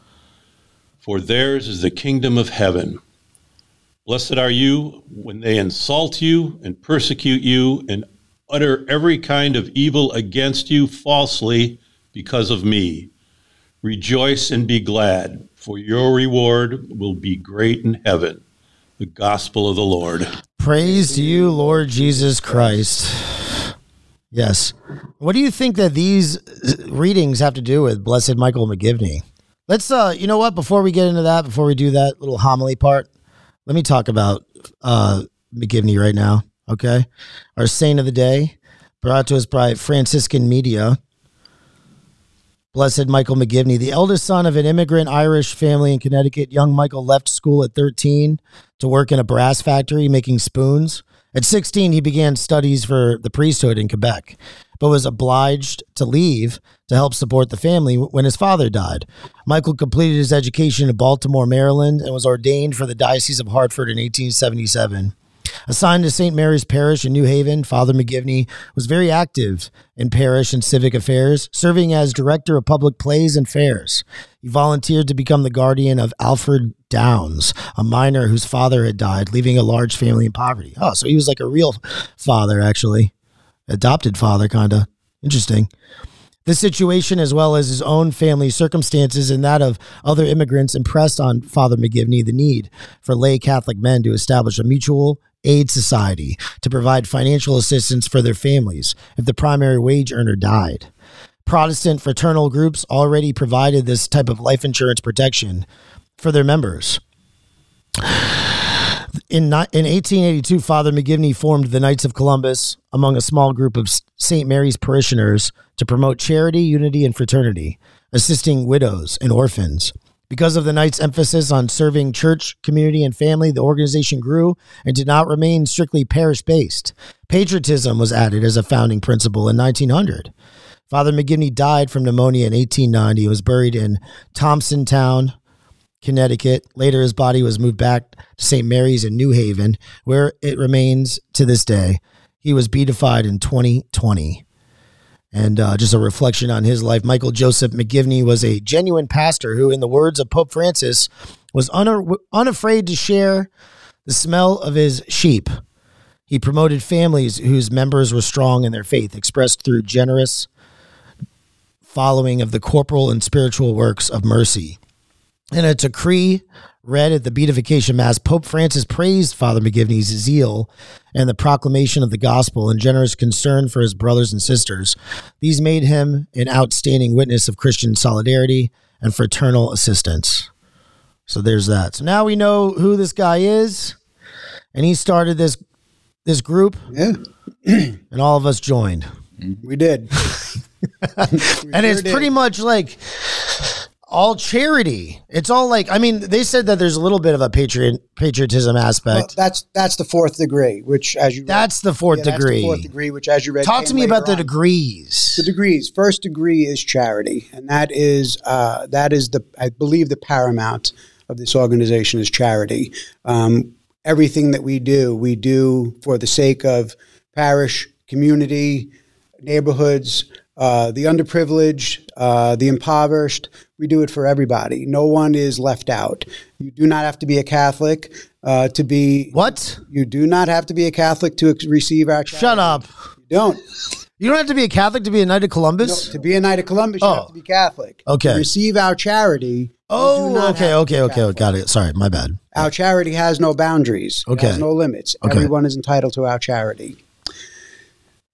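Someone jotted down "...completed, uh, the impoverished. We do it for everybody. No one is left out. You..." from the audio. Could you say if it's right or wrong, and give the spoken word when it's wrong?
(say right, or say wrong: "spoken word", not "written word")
wrong: "underprivileged", not "completed".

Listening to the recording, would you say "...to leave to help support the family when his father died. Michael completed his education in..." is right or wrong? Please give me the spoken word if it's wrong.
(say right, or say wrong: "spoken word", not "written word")
right.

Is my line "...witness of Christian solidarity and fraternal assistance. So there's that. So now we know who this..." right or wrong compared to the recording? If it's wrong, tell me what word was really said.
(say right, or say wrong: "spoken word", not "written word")
right.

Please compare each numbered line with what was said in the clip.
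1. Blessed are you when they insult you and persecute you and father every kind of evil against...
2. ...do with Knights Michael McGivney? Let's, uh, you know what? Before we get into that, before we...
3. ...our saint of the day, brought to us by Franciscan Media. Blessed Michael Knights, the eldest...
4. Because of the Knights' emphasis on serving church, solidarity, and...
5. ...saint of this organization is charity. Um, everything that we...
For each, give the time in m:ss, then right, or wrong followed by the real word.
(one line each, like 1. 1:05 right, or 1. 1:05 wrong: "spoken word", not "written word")
1. 0:04 wrong: "utter", not "father"
2. 0:27 wrong: "Blessed", not "Knights"
3. 0:37 wrong: "McGivney", not "Knights"
4. 2:00 wrong: "community", not "solidarity"
5. 3:30 wrong: "paramount", not "saint".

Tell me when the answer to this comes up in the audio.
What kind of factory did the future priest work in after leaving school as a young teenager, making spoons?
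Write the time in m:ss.
0:49.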